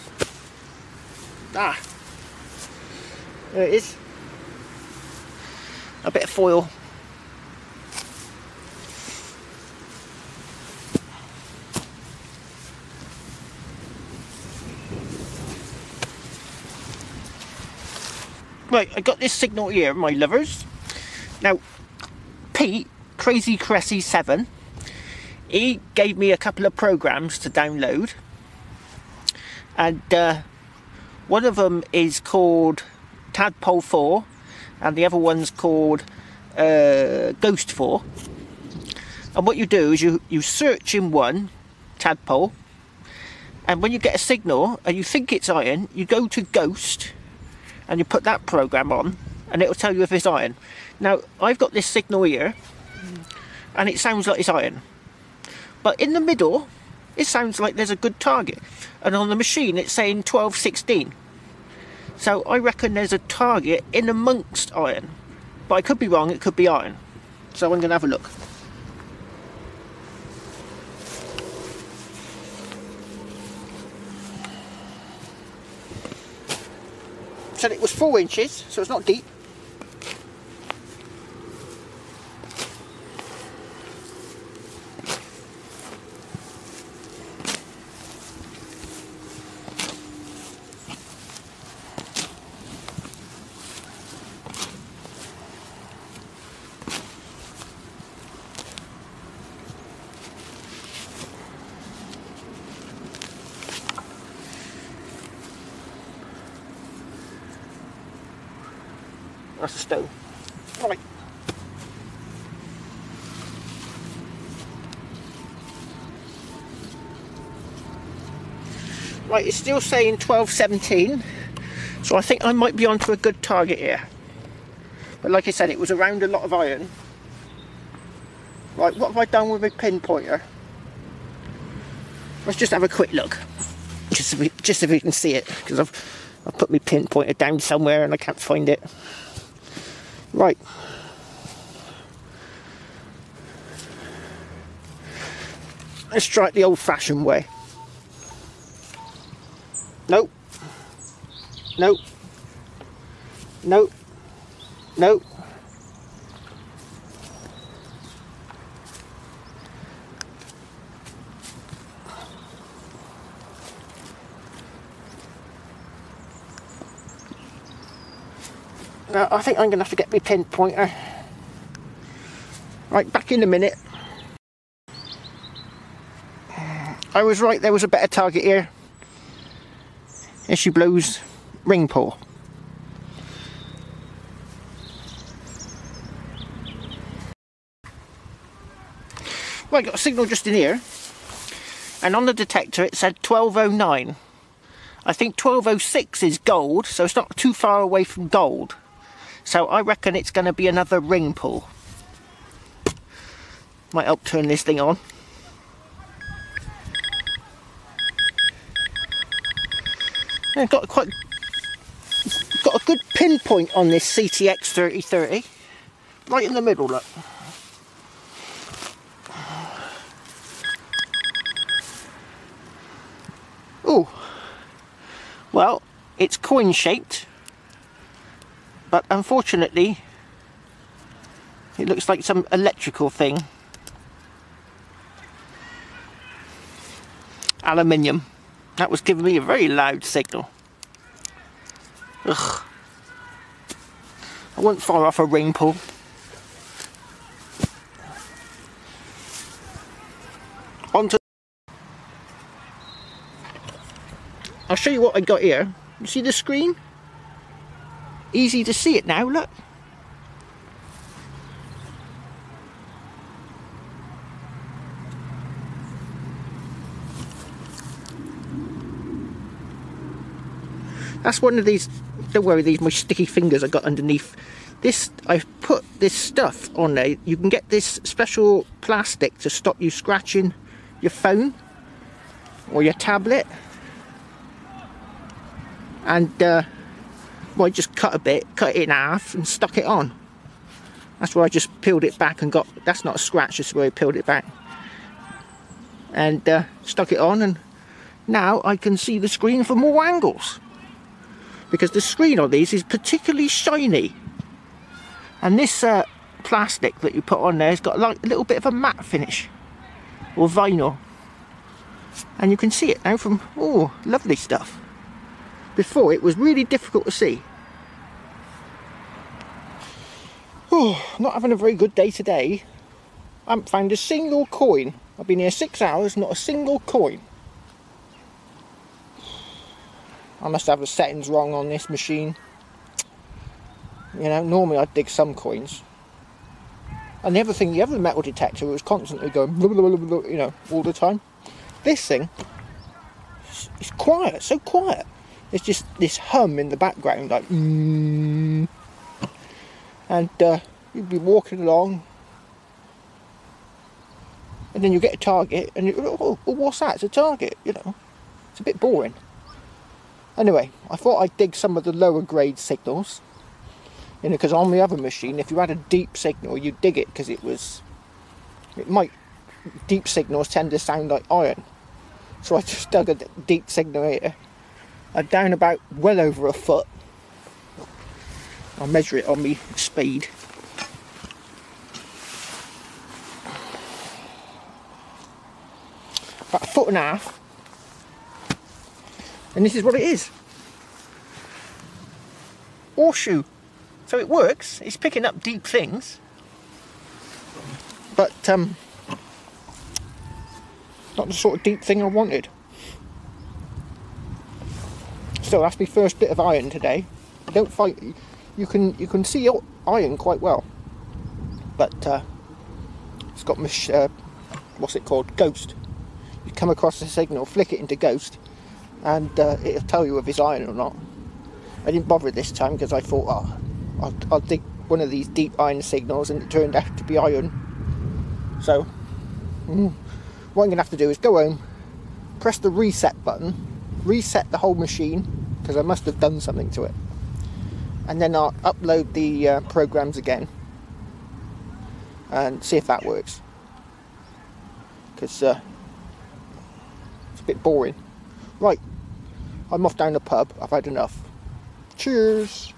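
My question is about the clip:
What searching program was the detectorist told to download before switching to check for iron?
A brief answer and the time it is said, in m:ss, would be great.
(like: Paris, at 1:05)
Tadpole 4, at 0:33.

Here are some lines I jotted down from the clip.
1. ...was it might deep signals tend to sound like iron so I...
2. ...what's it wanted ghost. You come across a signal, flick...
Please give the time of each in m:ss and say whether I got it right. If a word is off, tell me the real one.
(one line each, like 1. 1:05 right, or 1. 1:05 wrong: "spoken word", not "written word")
1. 6:07 right
2. 6:54 wrong: "called", not "wanted".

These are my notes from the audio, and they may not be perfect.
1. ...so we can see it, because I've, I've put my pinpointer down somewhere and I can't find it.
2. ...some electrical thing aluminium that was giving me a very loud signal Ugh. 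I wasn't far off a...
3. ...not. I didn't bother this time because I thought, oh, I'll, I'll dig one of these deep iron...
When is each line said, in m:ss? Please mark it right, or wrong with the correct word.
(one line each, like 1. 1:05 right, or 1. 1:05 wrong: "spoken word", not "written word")
1. 2:14 right
2. 3:52 right
3. 7:00 right.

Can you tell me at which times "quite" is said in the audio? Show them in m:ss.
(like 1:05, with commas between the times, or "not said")
3:30, 6:50.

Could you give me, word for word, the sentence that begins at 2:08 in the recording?
Right, what have I done with my pinpointer?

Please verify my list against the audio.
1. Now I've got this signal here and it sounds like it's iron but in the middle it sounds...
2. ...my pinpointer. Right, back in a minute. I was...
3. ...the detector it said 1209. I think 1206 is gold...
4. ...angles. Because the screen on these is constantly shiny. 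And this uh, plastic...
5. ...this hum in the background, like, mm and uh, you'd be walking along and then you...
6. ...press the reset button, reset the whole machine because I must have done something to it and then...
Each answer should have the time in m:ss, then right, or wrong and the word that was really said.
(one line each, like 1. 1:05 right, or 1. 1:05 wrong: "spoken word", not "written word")
1. 0:51 right
2. 2:50 right
3. 3:12 right
4. 5:00 wrong: "particularly", not "constantly"
5. 5:45 right
6. 7:12 right.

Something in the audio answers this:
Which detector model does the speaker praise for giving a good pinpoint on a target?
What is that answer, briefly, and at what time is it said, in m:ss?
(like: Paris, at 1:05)
CTX 3030, at 3:34.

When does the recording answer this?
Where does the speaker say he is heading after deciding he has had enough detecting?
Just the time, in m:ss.
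7:30.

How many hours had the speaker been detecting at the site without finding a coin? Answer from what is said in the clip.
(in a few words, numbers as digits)
6.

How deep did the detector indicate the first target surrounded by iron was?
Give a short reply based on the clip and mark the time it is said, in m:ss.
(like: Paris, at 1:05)
4 inches, at 1:17.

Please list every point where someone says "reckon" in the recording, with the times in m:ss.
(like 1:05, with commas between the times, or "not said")
1:02, 3:19.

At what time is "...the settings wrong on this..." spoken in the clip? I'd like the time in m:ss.
5:30.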